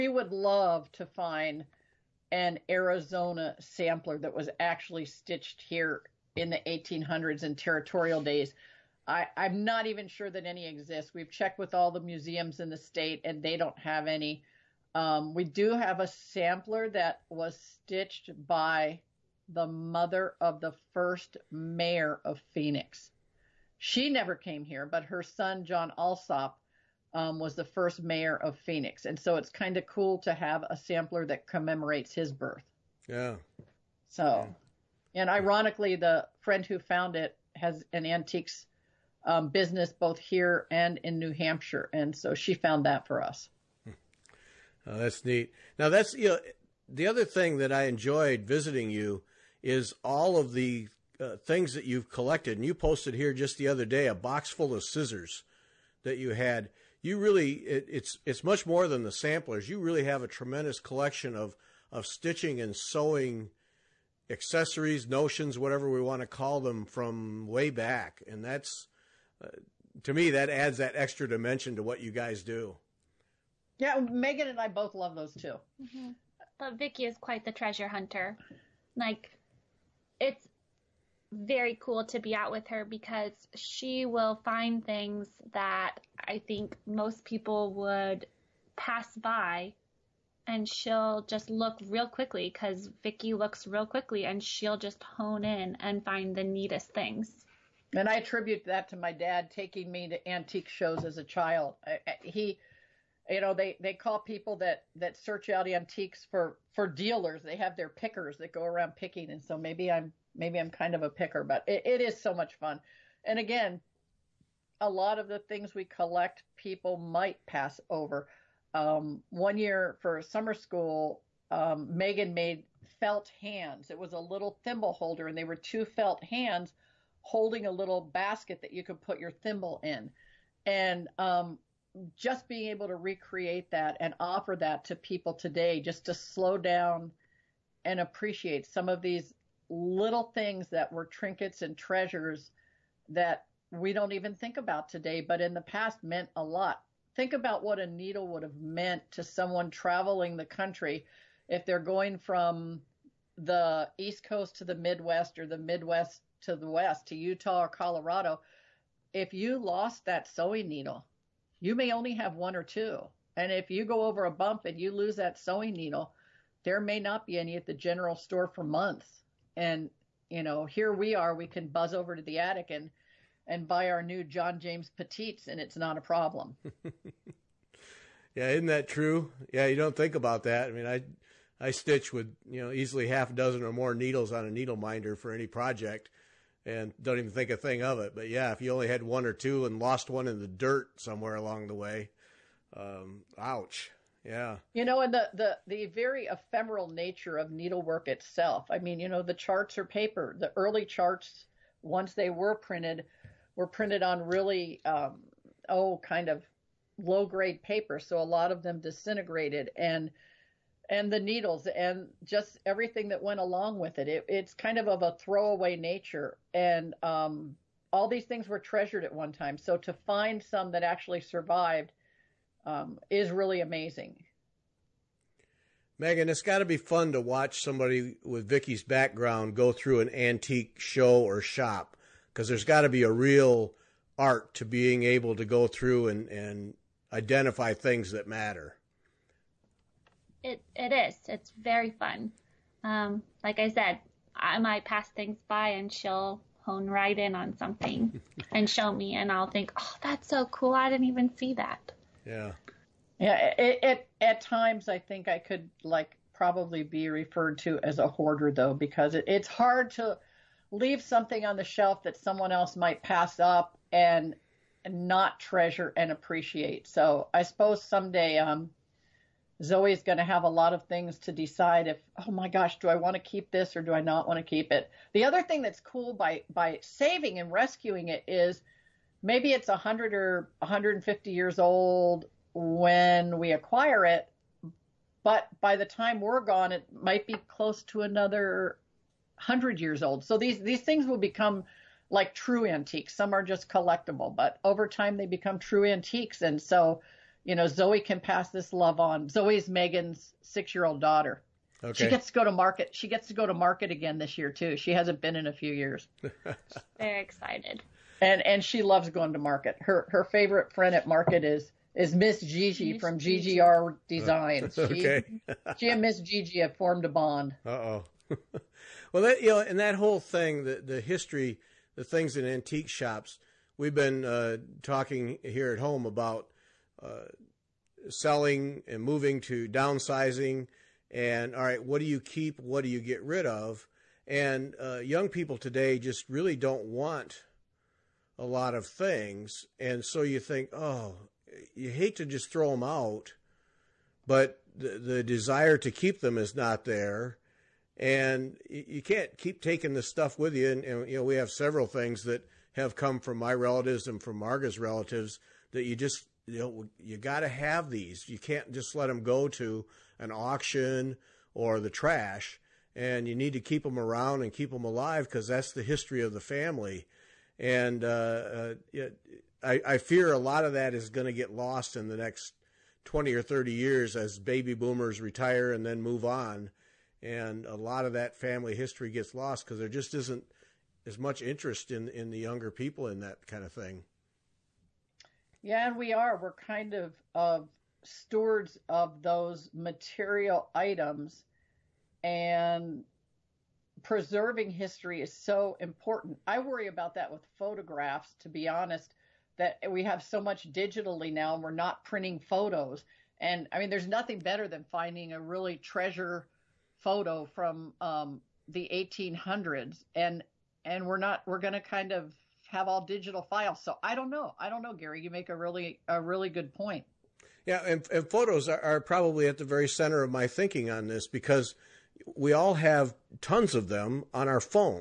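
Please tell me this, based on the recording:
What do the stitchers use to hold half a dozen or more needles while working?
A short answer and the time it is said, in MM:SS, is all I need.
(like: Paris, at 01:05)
Needle minder, at 03:04.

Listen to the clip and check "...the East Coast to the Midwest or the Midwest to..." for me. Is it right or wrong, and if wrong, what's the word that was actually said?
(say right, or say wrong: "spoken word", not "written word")
right.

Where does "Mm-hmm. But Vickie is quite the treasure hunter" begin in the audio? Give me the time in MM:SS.
01:15.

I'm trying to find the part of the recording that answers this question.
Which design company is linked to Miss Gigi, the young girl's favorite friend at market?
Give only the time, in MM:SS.
05:13.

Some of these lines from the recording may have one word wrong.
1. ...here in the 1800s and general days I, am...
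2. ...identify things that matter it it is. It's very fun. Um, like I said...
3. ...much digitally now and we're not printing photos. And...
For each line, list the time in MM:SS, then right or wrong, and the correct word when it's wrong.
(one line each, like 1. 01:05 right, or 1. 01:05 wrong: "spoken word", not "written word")
1. 00:05 wrong: "territorial", not "general"
2. 03:57 right
3. 06:40 right.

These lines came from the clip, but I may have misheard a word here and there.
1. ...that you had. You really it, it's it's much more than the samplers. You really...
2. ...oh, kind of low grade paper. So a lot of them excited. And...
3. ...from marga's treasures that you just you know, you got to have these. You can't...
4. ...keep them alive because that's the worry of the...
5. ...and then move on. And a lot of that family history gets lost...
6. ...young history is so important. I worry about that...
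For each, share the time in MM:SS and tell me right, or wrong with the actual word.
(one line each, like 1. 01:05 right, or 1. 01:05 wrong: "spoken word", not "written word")
1. 00:56 right
2. 03:25 wrong: "disintegrated", not "excited"
3. 05:54 wrong: "relatives", not "treasures"
4. 06:04 wrong: "history", not "worry"
5. 06:15 right
6. 06:34 wrong: "preserving", not "young".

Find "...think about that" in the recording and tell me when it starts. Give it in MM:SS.
02:59.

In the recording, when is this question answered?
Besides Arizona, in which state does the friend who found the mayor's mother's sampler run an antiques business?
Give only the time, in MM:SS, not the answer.
00:41.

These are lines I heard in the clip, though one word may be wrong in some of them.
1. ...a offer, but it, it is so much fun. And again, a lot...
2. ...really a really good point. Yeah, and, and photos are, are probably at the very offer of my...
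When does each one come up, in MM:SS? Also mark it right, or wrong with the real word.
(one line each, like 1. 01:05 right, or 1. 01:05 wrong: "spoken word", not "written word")
1. 01:51 wrong: "picker", not "offer"
2. 06:55 wrong: "center", not "offer".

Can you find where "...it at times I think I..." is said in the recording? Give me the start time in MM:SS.
04:13.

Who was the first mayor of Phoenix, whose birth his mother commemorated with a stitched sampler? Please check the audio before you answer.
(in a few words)
John Alsap.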